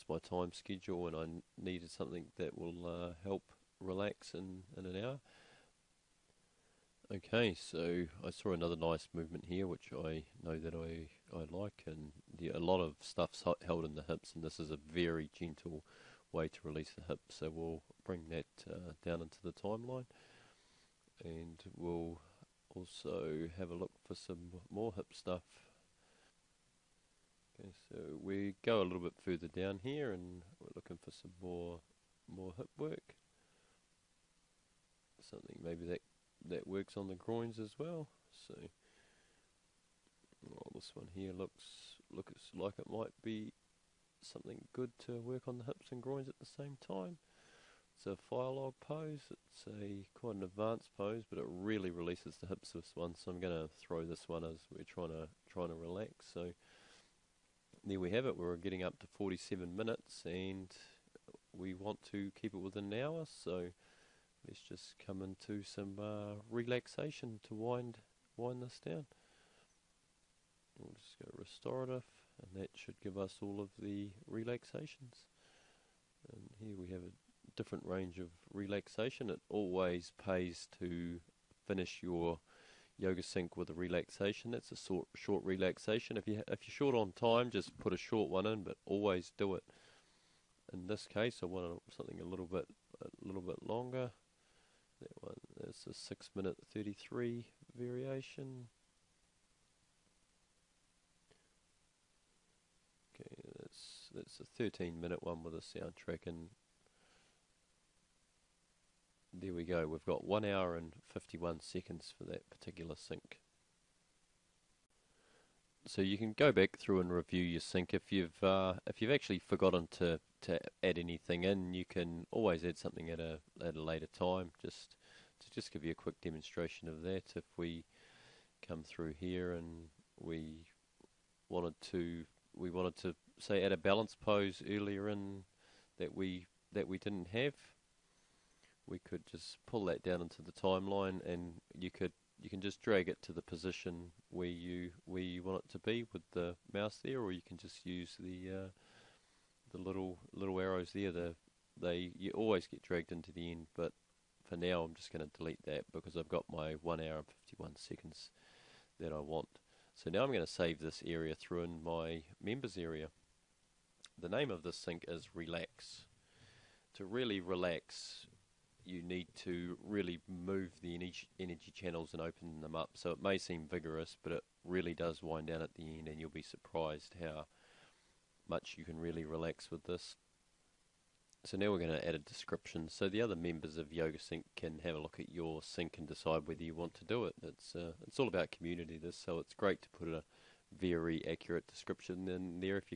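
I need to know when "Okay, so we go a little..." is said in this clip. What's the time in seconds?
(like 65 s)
27 s.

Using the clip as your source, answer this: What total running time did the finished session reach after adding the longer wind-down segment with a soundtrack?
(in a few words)
1 hour and 51 seconds.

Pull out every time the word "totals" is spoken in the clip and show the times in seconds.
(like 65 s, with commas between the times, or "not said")
not said.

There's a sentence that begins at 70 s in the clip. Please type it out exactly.
We'll just go restorative, and that should give us all of the relaxations.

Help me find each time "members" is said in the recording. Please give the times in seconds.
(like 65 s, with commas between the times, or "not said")
162 s, 183 s.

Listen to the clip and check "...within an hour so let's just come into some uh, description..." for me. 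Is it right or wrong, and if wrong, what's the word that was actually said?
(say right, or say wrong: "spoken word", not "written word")
wrong: "relaxation", not "description".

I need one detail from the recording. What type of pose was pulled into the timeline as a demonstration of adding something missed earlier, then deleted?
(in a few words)
Balance pose.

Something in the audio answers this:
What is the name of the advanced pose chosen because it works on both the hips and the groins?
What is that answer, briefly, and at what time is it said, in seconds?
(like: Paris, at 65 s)
Fire log pose, at 48 s.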